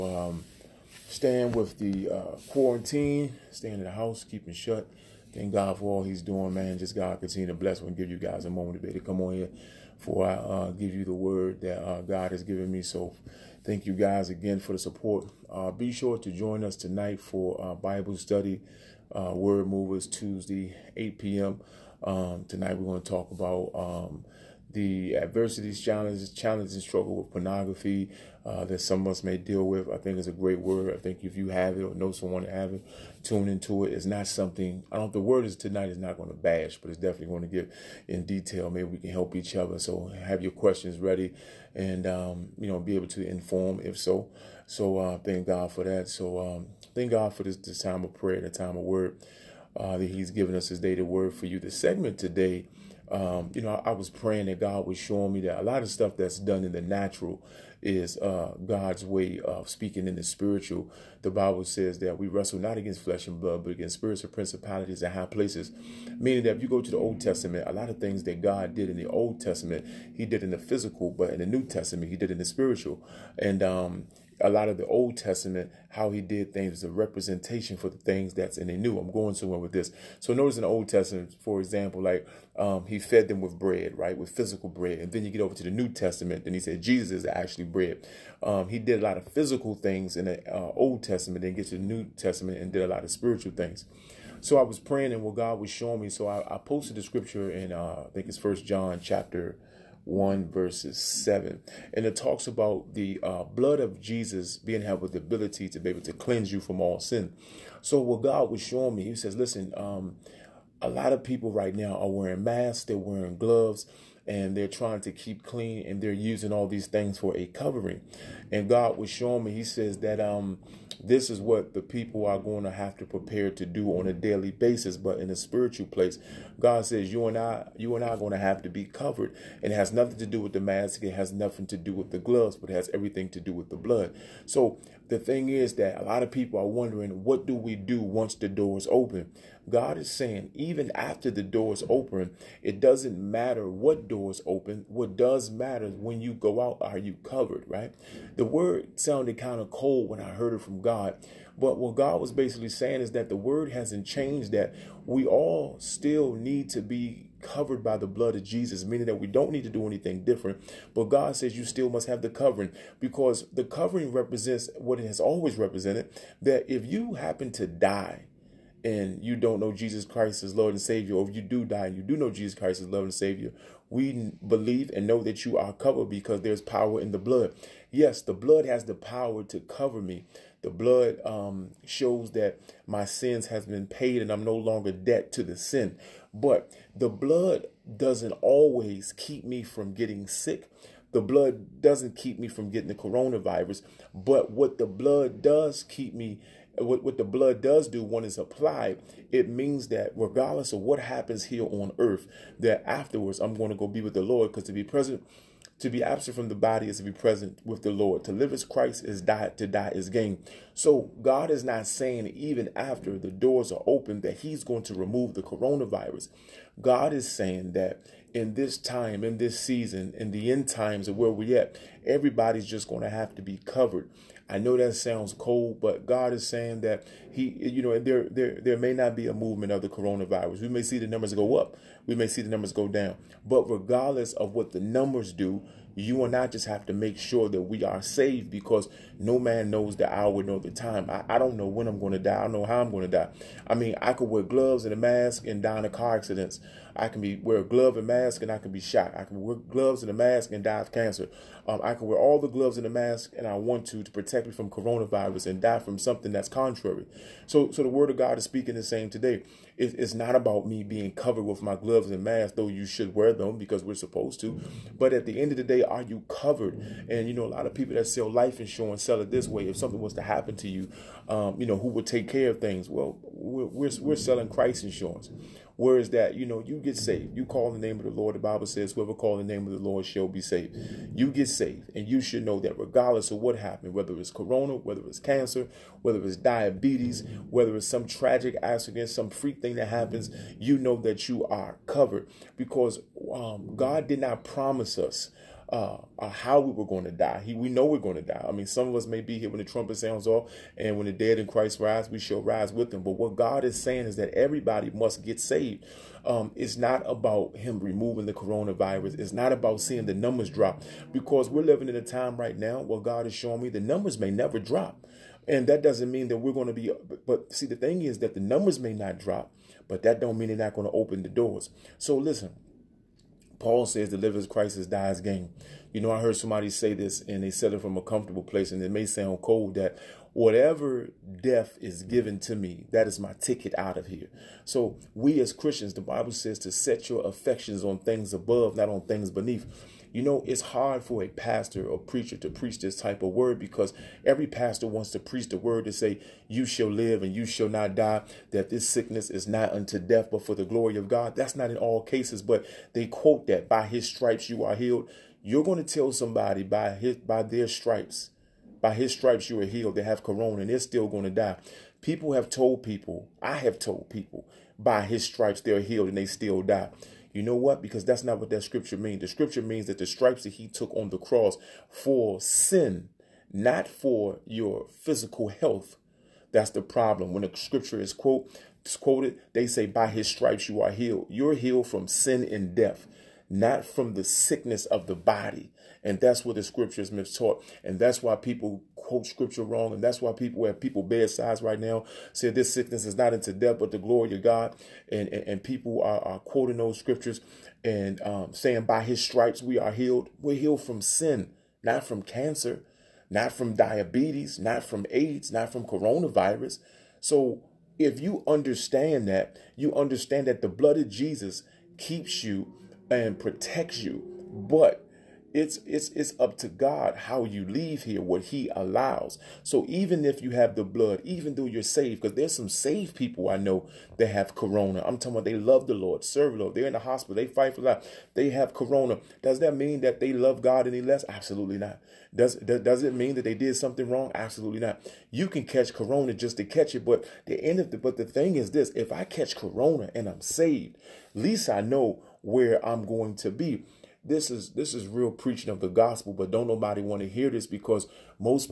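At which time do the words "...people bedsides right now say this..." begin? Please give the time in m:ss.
6:30.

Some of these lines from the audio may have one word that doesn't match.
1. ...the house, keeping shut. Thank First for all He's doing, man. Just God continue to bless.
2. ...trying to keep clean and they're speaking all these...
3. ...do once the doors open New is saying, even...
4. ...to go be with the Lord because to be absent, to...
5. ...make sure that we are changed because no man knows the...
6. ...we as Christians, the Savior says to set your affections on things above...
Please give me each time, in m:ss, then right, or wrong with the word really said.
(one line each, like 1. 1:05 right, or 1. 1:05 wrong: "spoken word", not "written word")
1. 0:03 wrong: "God", not "First"
2. 1:54 wrong: "using", not "speaking"
3. 2:17 wrong: "God", not "New"
4. 3:23 wrong: "present", not "absent"
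5. 3:56 wrong: "saved", not "changed"
6. 5:35 wrong: "Bible", not "Savior".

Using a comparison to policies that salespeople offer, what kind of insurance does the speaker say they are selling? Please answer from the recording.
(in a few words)
Christ insurance.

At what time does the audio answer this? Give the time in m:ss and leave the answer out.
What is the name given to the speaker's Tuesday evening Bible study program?
0:19.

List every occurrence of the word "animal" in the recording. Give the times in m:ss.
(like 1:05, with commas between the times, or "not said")
not said.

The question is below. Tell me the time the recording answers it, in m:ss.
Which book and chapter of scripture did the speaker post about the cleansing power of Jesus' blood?
1:38.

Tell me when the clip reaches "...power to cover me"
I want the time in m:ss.
2:58.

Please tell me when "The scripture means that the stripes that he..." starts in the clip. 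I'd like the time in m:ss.
6:09.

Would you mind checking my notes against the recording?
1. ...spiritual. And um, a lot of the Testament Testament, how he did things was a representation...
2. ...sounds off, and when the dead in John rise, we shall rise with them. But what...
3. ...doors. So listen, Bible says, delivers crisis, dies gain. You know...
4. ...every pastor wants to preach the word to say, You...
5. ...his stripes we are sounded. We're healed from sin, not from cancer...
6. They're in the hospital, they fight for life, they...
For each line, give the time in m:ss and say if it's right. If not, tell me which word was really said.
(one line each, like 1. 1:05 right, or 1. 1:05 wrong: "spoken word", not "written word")
1. 1:12 wrong: "Old", not "Testament"
2. 4:59 wrong: "Christ", not "John"
3. 5:21 wrong: "Paul", not "Bible"
4. 5:44 right
5. 6:39 wrong: "healed", not "sounded"
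6. 7:06 right.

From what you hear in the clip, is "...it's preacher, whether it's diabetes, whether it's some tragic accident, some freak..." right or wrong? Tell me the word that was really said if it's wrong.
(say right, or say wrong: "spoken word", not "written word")
wrong: "cancer", not "preacher".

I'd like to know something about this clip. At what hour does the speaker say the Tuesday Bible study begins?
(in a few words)
8 p.m.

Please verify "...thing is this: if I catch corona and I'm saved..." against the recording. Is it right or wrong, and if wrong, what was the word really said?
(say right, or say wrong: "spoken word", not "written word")
right.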